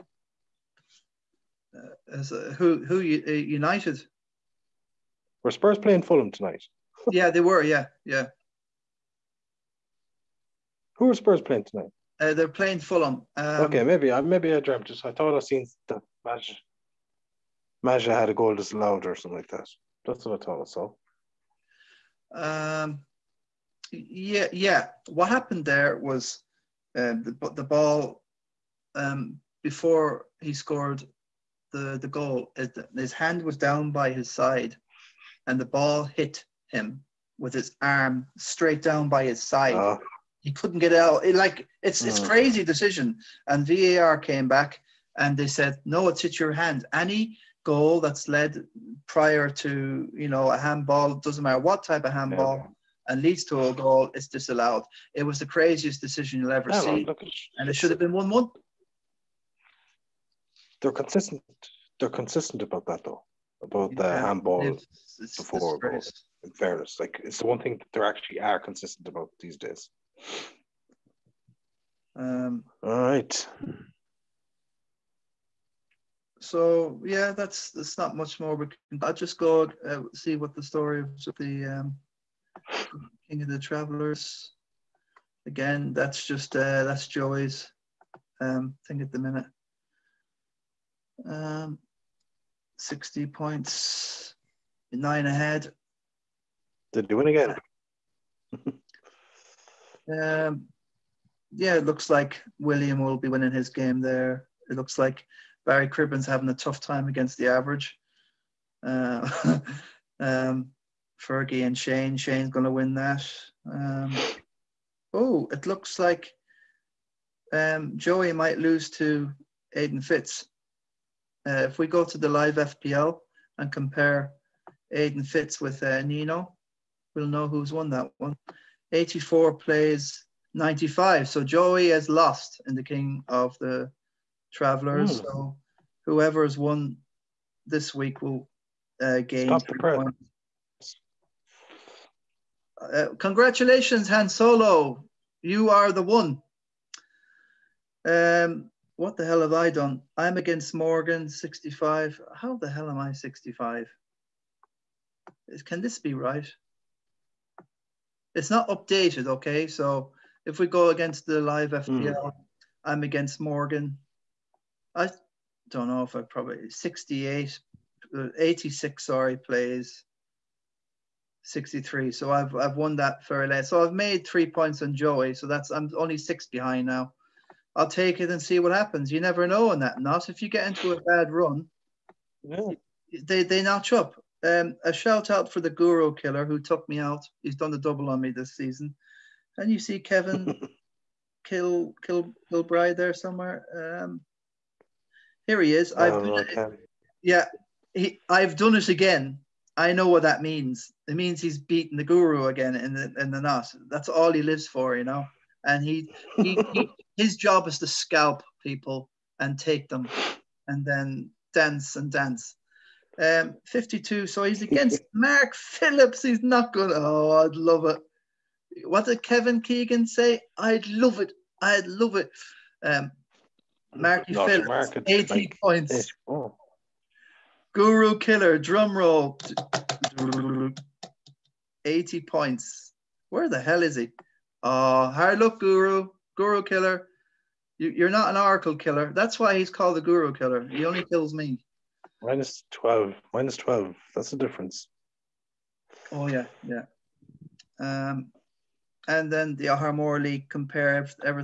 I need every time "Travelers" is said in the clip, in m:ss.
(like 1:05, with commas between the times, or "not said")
1:23, 2:14.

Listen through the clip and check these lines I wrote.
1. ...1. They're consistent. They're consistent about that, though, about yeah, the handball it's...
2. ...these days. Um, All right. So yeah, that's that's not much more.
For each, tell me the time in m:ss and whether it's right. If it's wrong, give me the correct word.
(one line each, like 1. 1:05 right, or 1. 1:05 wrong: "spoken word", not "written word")
1. 0:58 right
2. 1:09 right.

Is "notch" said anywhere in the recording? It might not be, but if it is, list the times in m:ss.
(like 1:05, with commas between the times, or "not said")
3:03.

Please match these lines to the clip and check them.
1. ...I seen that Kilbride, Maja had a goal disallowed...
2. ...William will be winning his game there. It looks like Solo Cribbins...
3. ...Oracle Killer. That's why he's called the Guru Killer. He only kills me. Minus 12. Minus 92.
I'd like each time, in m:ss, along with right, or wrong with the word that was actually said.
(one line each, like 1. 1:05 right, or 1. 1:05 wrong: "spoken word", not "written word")
1. 0:15 wrong: "Maja", not "Kilbride"
2. 1:42 wrong: "Barry", not "Solo"
3. 3:58 wrong: "12", not "92".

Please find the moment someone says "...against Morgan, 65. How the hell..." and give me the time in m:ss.
2:30.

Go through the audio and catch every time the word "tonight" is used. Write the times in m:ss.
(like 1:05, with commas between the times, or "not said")
0:06, 0:11.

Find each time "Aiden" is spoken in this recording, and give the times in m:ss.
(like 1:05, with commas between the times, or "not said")
1:59, 2:04.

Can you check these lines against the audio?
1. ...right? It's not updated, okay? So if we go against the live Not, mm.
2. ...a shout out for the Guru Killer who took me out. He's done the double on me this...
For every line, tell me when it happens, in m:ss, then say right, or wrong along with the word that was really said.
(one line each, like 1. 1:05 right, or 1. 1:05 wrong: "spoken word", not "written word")
1. 2:36 wrong: "FPL", not "Not"
2. 3:04 right.